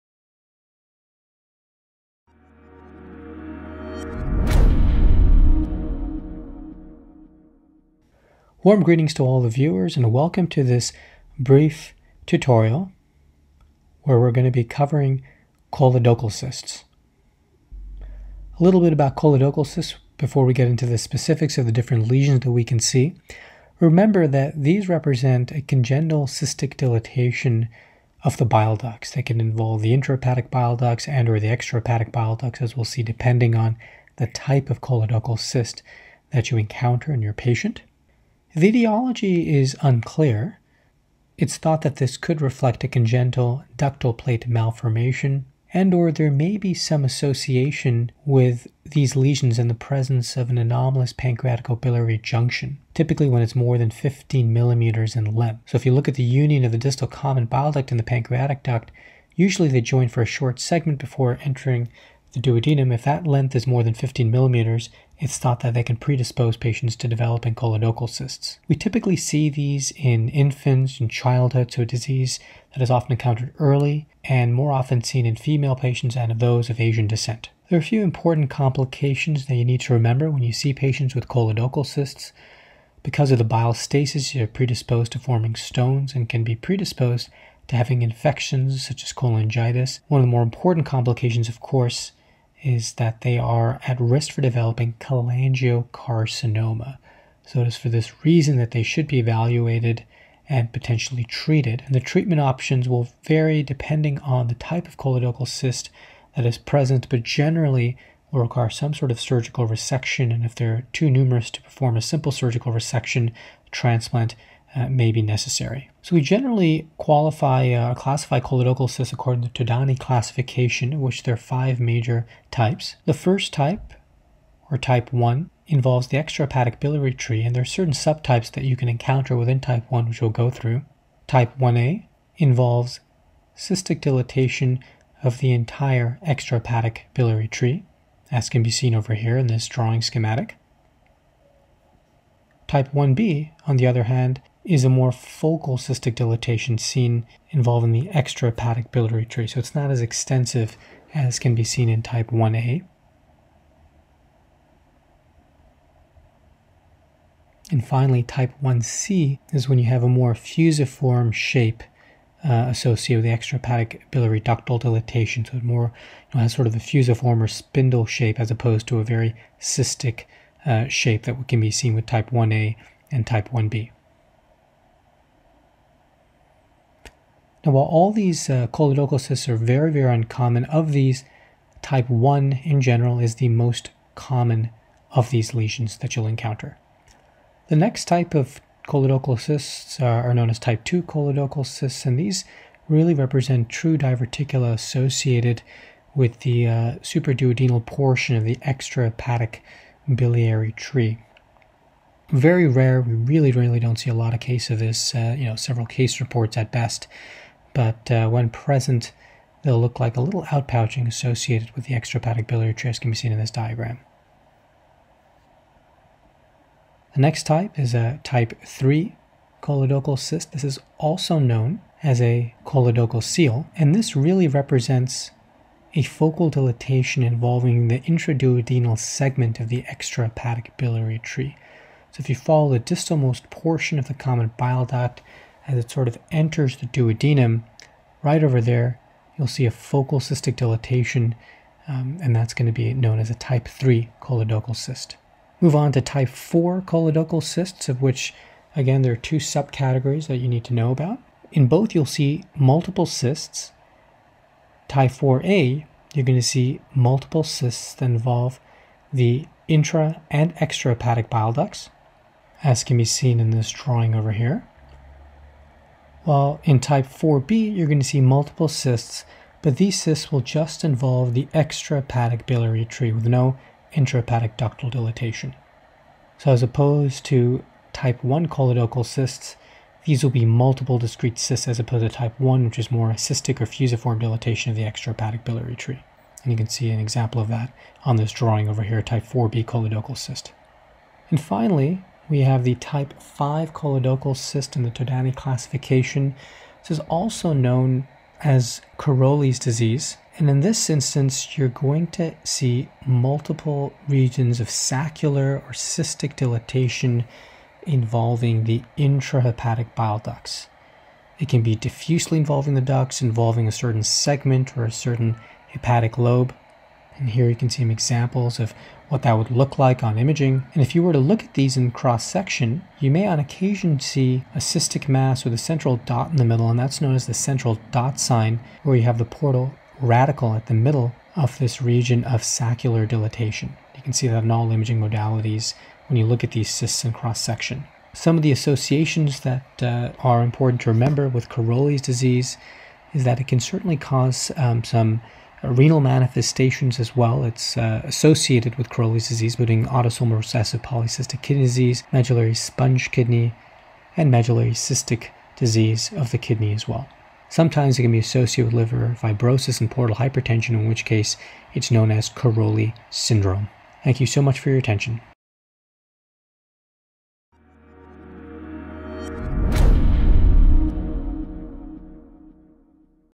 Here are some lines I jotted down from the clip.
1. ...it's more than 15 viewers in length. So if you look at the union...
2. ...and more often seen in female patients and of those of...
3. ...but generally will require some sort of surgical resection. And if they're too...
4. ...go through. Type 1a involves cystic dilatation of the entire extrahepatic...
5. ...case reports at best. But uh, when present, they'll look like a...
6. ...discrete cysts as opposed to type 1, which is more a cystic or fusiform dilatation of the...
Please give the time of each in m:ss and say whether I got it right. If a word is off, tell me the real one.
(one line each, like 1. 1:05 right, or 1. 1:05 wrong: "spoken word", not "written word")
1. 0:53 wrong: "millimeters", not "viewers"
2. 1:14 right
3. 1:47 right
4. 2:10 right
5. 3:25 right
6. 4:40 right.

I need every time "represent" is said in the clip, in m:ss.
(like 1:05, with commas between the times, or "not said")
0:24, 3:13, 3:44.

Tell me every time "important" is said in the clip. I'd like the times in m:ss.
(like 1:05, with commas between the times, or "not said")
1:18, 1:30, 5:40.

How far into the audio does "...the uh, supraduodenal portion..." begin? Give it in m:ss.
3:16.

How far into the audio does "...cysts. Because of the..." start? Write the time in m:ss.
1:21.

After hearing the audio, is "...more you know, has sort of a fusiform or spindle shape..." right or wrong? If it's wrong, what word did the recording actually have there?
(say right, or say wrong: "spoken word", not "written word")
right.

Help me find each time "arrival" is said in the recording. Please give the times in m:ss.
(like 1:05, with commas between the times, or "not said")
not said.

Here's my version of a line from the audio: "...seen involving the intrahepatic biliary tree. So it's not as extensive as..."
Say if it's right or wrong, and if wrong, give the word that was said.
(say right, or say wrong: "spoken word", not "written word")
wrong: "extrahepatic", not "intrahepatic".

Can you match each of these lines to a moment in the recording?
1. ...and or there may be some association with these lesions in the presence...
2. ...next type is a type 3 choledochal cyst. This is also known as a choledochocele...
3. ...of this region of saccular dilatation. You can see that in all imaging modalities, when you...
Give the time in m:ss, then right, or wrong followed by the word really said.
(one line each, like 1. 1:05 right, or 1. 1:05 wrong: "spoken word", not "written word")
1. 0:45 right
2. 3:37 right
3. 5:31 right.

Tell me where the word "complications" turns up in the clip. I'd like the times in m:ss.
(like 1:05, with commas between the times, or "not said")
1:18, 1:30.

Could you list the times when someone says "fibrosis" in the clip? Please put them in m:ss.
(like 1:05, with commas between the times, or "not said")
5:59.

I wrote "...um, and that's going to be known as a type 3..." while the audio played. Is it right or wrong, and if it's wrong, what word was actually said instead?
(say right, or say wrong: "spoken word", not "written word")
right.